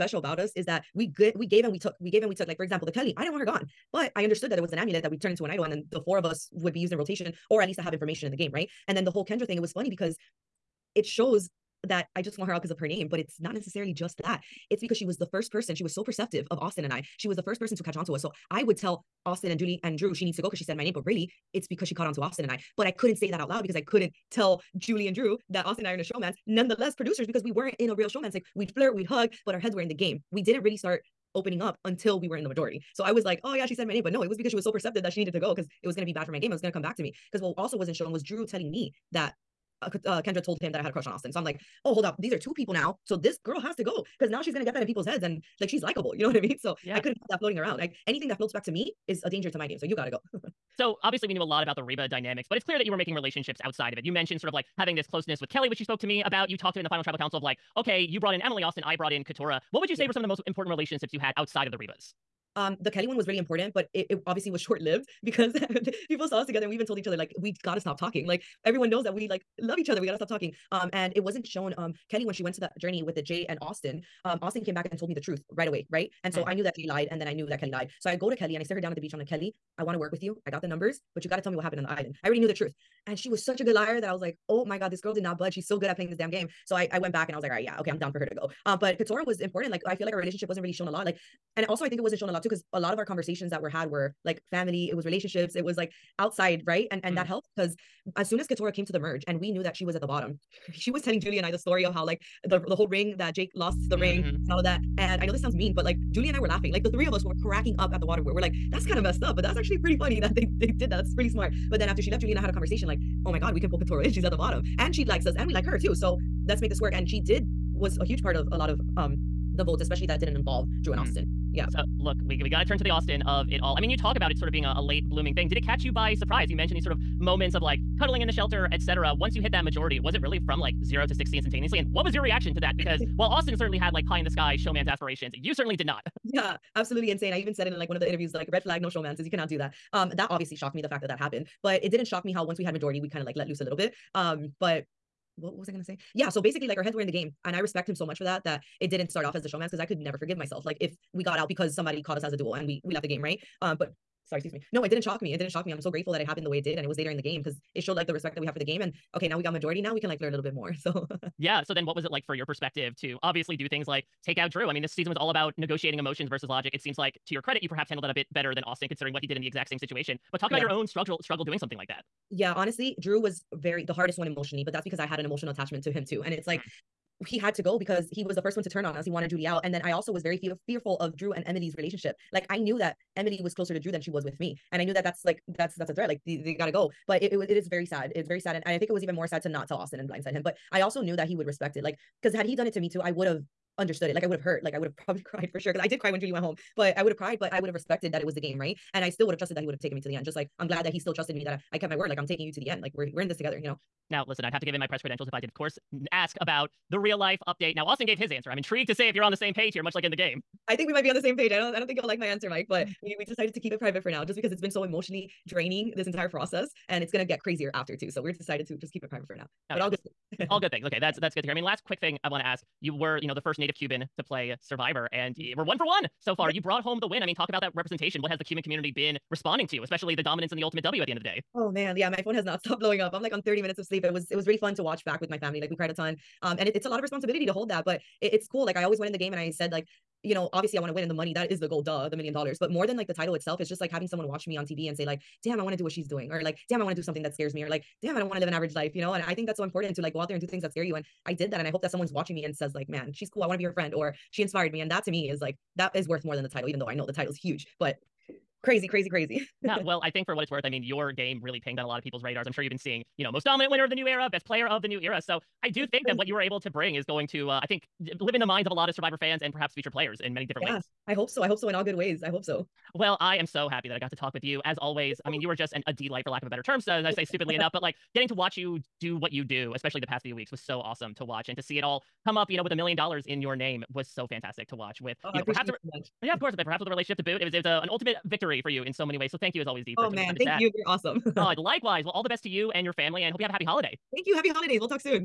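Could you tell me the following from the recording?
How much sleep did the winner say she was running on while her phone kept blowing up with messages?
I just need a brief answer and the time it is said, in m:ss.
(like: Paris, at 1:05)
30 minutes, at 3:53.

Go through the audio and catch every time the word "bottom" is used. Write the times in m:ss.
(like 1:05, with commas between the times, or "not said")
1:40, 1:54.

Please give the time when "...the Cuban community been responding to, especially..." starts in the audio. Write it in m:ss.
3:48.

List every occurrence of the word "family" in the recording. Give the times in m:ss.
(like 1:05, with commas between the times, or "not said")
1:34, 3:55, 4:52.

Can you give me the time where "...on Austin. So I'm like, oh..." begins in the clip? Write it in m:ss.
0:41.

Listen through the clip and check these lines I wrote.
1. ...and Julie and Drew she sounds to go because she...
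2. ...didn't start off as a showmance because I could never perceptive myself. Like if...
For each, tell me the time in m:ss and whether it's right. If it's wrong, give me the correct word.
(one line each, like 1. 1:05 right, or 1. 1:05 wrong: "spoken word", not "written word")
1. 0:19 wrong: "needs", not "sounds"
2. 2:28 wrong: "forgive", not "perceptive".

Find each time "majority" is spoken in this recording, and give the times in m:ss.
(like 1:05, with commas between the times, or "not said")
0:32, 2:09, 2:22, 2:39.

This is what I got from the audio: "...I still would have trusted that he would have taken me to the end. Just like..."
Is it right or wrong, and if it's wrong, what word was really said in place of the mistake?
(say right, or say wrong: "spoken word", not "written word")
right.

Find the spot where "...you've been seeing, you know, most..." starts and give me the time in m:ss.
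4:22.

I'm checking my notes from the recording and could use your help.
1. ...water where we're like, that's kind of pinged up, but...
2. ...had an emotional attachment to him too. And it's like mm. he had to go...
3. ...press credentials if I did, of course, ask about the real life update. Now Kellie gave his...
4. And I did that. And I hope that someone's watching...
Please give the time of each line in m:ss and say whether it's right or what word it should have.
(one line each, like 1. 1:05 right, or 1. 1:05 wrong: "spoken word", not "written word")
1. 1:48 wrong: "messed", not "pinged"
2. 2:55 right
3. 3:24 wrong: "Austin", not "Kellie"
4. 4:10 right.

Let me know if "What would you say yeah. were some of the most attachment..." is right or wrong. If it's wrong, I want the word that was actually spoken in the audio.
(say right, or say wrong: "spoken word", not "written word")
wrong: "important", not "attachment".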